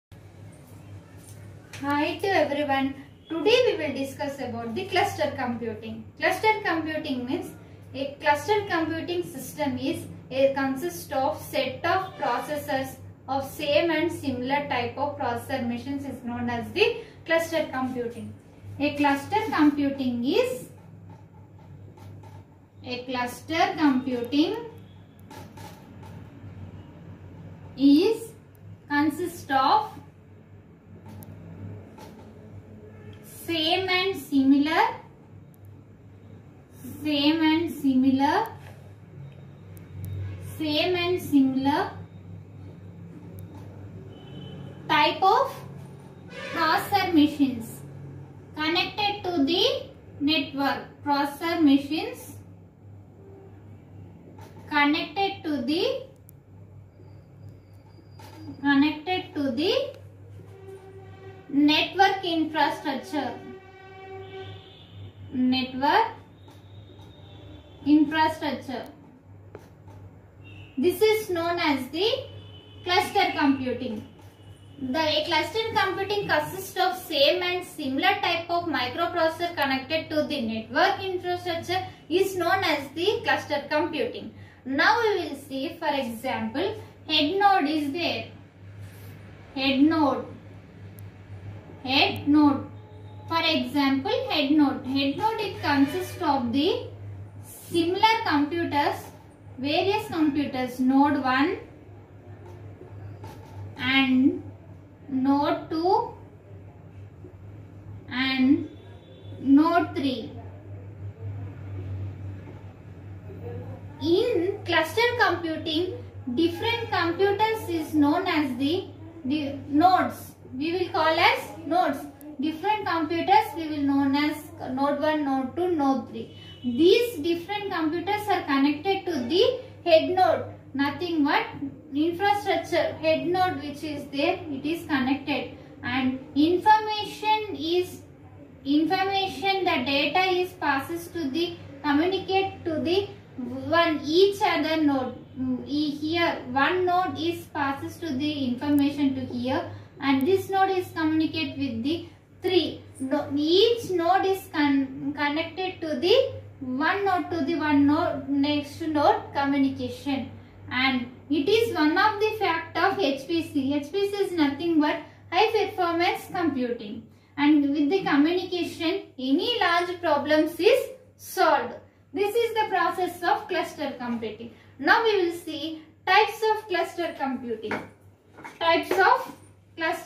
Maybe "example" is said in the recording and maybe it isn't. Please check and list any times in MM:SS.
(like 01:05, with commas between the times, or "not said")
01:26, 01:33.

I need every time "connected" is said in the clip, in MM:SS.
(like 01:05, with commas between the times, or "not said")
00:48, 00:54, 01:19, 02:08, 02:14, 02:35.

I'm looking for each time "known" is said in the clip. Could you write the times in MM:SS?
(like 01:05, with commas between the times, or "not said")
00:16, 01:11, 01:22, 01:57, 02:03.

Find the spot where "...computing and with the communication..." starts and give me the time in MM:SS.
02:46.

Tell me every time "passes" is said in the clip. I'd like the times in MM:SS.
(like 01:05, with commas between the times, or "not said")
02:20, 02:27.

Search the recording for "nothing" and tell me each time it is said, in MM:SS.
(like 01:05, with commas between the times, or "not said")
02:10, 02:44.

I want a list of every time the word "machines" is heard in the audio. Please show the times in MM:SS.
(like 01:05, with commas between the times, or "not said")
00:15, 00:47, 00:51.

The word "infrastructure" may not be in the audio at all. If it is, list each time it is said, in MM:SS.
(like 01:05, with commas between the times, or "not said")
01:02, 01:07, 01:21, 02:11.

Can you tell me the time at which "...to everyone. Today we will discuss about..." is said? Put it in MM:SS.
00:02.